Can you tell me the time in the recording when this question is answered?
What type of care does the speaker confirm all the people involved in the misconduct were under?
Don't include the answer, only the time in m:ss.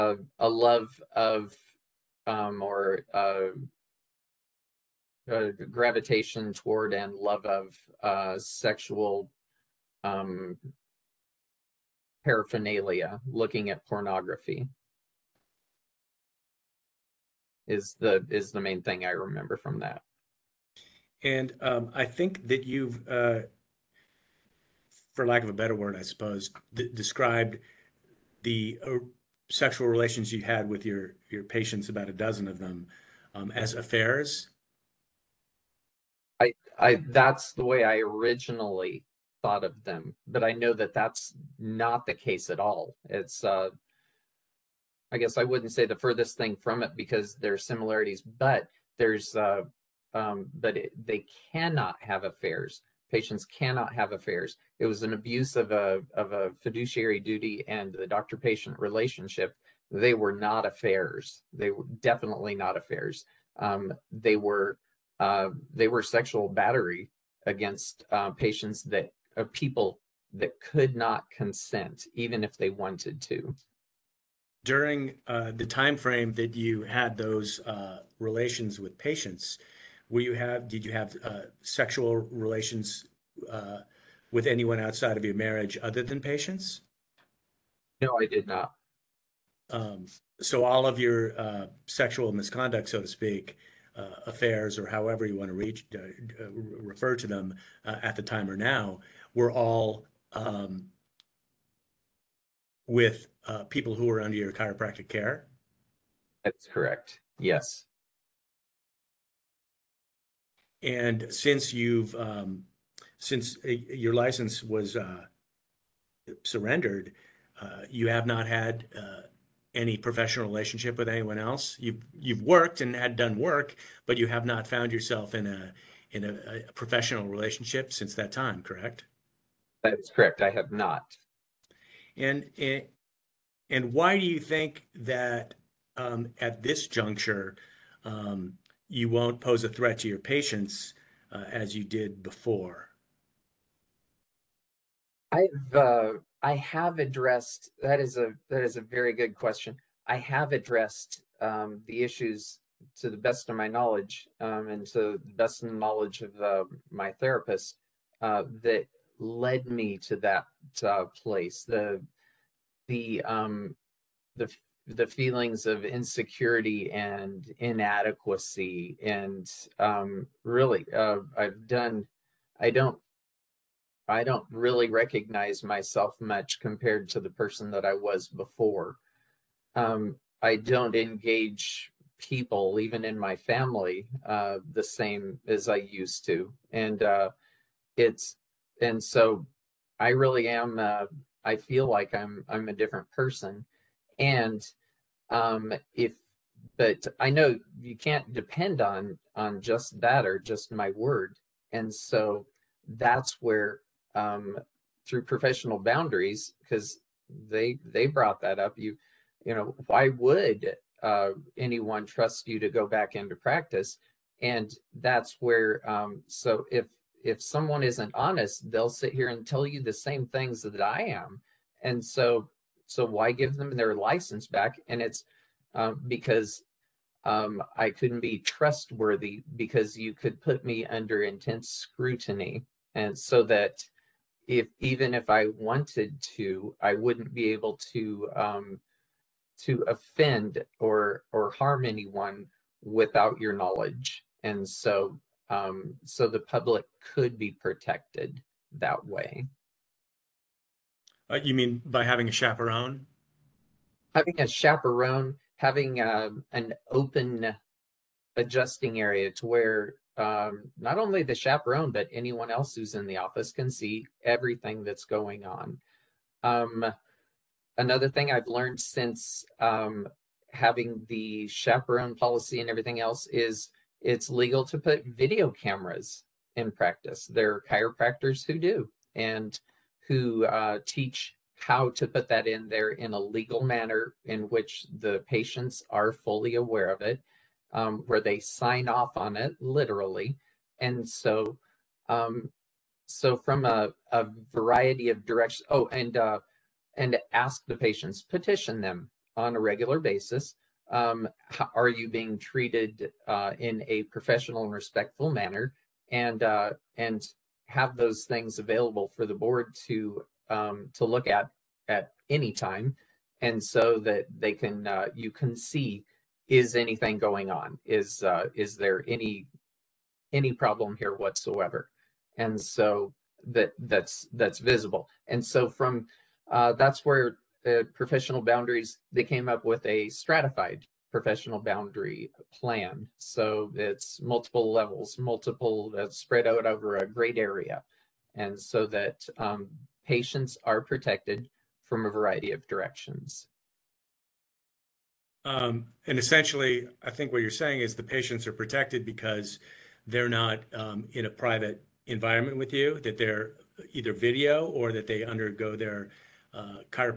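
1:44.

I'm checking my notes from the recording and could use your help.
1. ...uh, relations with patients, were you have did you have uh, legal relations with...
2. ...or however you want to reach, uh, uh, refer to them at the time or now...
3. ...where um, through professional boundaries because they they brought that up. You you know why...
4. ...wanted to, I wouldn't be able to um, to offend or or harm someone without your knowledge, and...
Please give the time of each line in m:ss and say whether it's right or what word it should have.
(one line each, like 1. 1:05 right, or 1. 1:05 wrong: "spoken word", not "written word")
1. 1:17 wrong: "sexual", not "legal"
2. 1:34 right
3. 3:23 right
4. 3:55 wrong: "anyone", not "someone".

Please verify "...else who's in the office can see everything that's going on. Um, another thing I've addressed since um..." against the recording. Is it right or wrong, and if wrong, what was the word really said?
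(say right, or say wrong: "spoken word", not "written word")
wrong: "learned", not "addressed".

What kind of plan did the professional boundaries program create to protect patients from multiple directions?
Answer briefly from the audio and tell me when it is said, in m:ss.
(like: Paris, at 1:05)
stratified professional boundary plan, at 5:30.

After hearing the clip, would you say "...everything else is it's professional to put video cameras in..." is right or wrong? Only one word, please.
wrong.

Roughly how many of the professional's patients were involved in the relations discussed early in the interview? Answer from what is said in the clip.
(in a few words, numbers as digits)
about a dozen.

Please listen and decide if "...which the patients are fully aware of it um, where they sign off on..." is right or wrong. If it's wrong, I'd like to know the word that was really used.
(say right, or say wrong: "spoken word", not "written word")
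right.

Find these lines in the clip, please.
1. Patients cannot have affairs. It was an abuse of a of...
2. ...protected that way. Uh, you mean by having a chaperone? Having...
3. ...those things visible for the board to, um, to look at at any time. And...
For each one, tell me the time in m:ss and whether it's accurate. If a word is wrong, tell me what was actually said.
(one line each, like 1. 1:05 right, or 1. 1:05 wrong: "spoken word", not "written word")
1. 0:53 right
2. 4:07 right
3. 5:07 wrong: "available", not "visible".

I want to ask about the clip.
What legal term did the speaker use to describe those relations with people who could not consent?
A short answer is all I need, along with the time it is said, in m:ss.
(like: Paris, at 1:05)
sexual battery, at 1:06.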